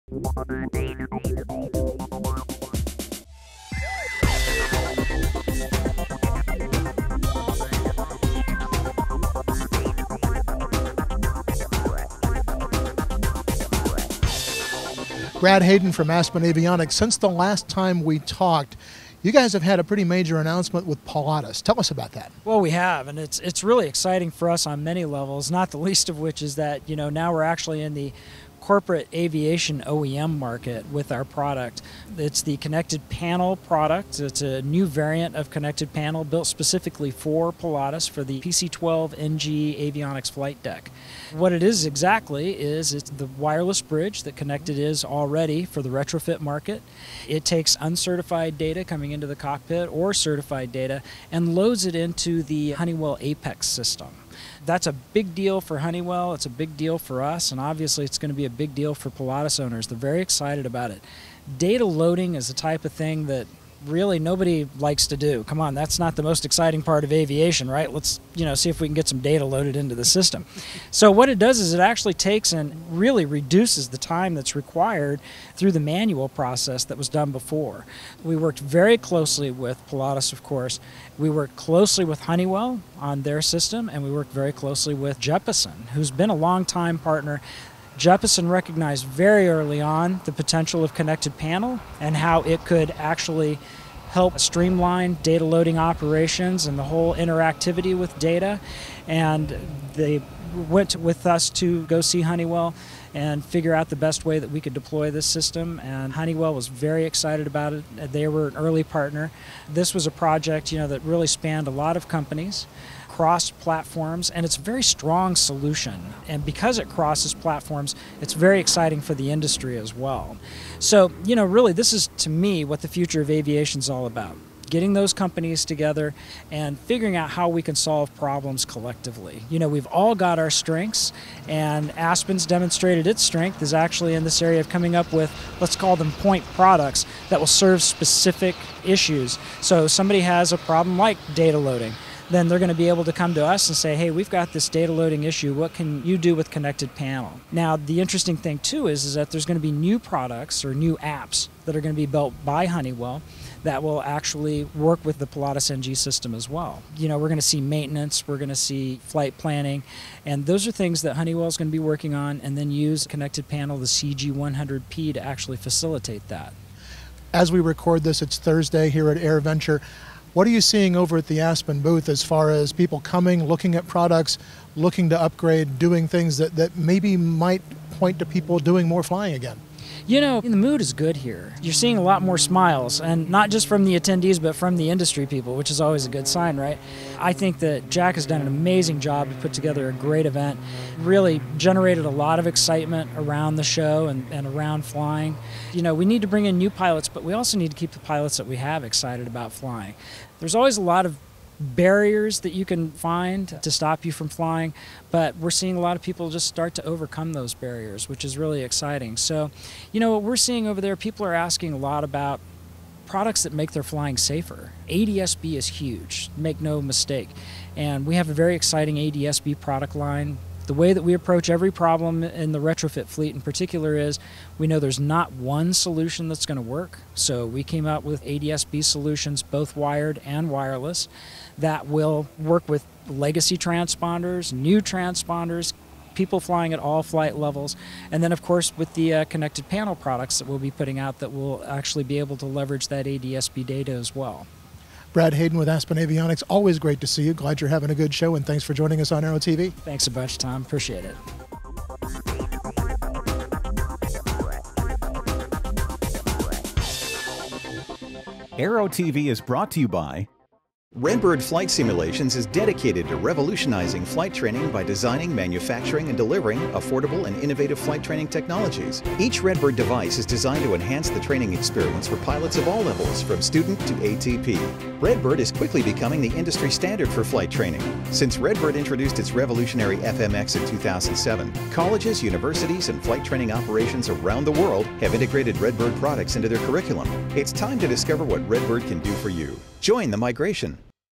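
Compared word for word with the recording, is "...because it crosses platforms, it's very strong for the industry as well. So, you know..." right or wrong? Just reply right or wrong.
wrong.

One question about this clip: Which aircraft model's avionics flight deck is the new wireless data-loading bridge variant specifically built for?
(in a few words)
PC-12NG.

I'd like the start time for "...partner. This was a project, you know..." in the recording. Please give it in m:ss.
1:48.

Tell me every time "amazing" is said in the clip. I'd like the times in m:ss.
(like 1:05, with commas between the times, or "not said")
3:08.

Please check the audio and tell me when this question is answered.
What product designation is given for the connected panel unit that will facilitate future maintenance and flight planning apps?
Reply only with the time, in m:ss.
2:43.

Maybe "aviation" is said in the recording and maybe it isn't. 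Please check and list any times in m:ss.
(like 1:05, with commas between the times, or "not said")
0:29, 1:07, 2:03.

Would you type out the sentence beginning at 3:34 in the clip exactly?
ADS-B is huge, make no mistake.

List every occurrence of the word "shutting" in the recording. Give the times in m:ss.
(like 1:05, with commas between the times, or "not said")
not said.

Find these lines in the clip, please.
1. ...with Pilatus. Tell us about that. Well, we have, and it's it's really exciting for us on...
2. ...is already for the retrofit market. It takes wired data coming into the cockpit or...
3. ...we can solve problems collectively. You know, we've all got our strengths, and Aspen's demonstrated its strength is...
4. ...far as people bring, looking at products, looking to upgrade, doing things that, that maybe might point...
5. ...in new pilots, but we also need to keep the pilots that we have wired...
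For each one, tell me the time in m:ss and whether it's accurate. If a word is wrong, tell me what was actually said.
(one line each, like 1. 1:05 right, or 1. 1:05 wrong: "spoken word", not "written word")
1. 0:20 right
2. 0:44 wrong: "uncertified", not "wired"
3. 2:07 right
4. 2:52 wrong: "coming", not "bring"
5. 3:16 wrong: "excited", not "wired".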